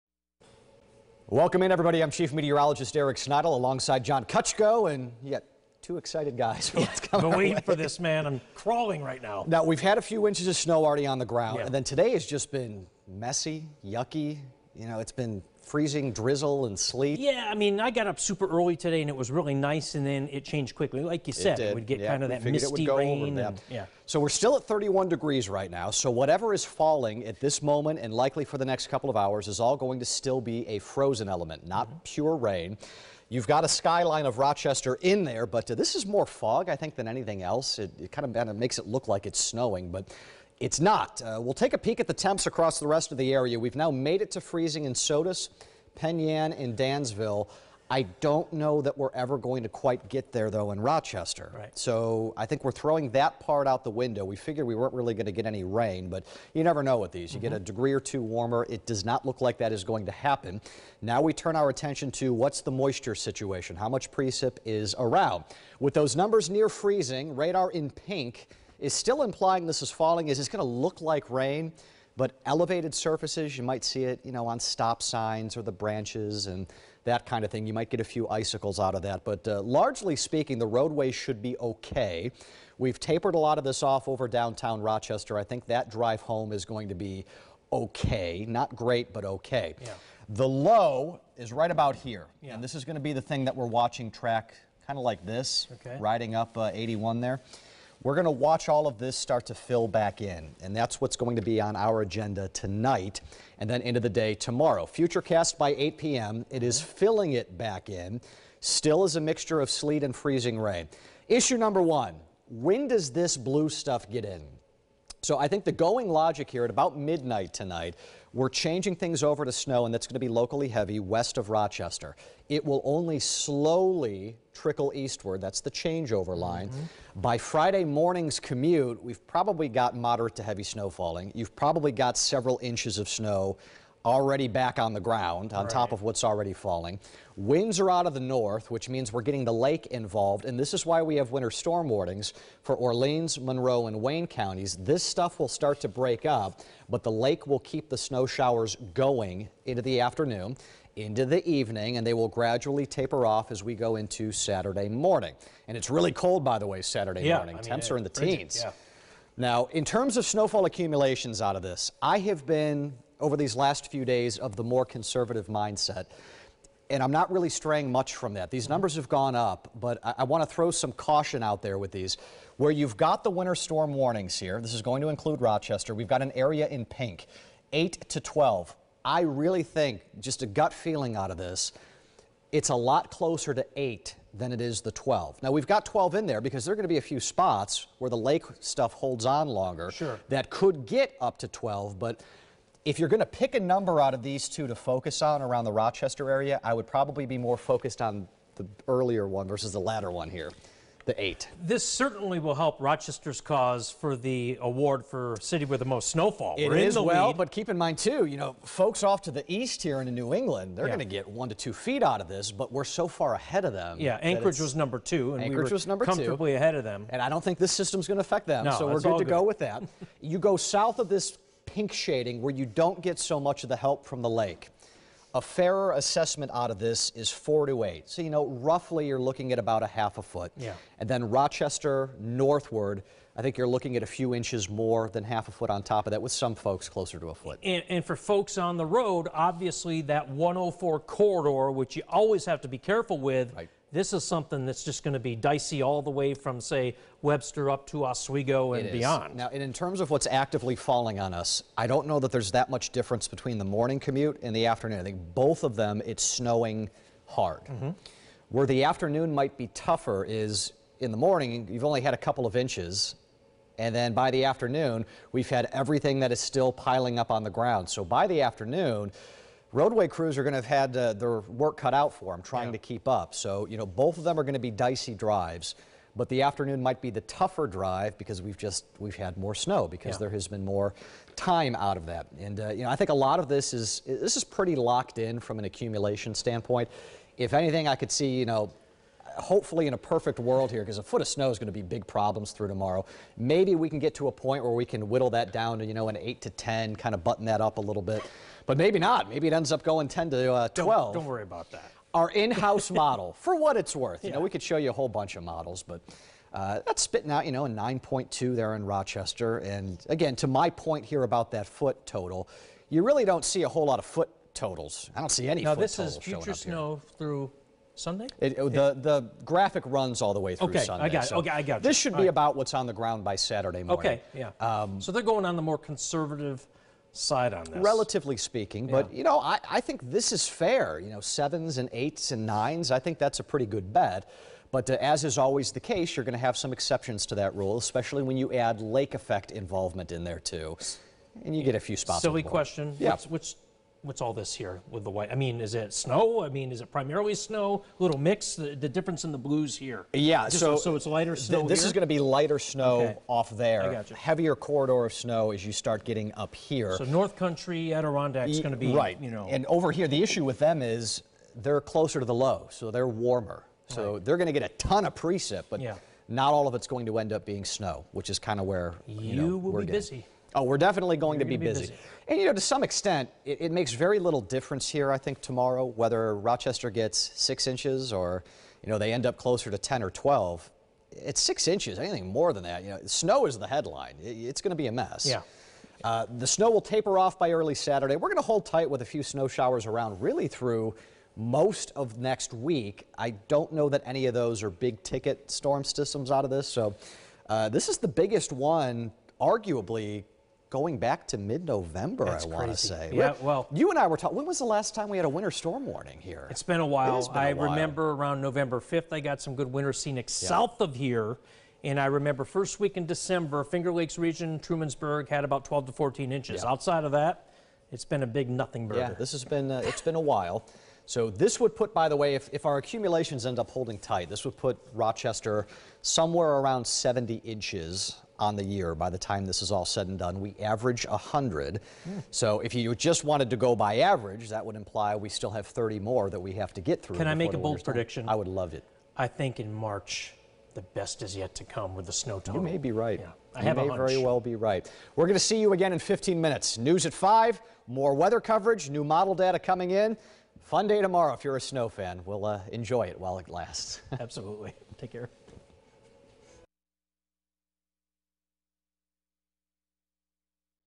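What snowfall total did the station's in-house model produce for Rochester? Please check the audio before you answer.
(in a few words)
9.2.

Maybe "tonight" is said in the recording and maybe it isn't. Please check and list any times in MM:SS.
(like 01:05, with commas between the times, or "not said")
01:42, 01:57.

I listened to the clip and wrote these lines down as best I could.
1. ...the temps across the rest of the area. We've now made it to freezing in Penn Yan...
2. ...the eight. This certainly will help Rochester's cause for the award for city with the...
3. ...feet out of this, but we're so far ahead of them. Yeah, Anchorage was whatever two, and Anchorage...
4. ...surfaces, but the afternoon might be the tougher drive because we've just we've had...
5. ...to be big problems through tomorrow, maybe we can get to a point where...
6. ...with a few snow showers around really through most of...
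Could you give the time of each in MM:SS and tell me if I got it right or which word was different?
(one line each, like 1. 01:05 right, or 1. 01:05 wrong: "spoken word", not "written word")
1. 00:42 right
2. 03:21 right
3. 03:31 wrong: "number", not "whatever"
4. 04:35 wrong: "drives", not "surfaces"
5. 04:51 right
6. 06:28 right.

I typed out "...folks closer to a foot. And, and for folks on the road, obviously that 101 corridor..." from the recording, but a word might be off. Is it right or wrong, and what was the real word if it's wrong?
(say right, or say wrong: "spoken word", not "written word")
wrong: "104", not "101".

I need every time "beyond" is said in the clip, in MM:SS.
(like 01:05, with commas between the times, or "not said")
04:08.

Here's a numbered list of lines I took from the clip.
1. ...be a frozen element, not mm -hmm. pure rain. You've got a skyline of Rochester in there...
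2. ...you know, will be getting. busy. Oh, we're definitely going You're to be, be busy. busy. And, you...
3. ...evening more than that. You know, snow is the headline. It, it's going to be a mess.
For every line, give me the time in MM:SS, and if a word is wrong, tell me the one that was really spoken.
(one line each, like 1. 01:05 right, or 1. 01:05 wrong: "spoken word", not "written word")
1. 00:30 right
2. 06:09 right
3. 06:21 wrong: "anything", not "evening".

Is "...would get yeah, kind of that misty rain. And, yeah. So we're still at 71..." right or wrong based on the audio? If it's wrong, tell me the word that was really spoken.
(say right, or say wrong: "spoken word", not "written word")
wrong: "31", not "71".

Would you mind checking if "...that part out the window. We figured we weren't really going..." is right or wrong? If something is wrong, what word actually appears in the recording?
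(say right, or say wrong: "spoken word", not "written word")
right.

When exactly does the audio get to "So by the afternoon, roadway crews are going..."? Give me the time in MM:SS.
04:27.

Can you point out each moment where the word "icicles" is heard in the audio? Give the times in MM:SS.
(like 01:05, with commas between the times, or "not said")
01:18.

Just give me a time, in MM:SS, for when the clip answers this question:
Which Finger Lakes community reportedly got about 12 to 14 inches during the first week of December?
06:54.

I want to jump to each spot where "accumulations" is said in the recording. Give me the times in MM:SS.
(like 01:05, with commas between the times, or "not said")
02:40, 04:45, 07:02.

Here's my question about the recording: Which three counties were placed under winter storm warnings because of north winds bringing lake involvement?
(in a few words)
Orleans, Monroe, and Wayne.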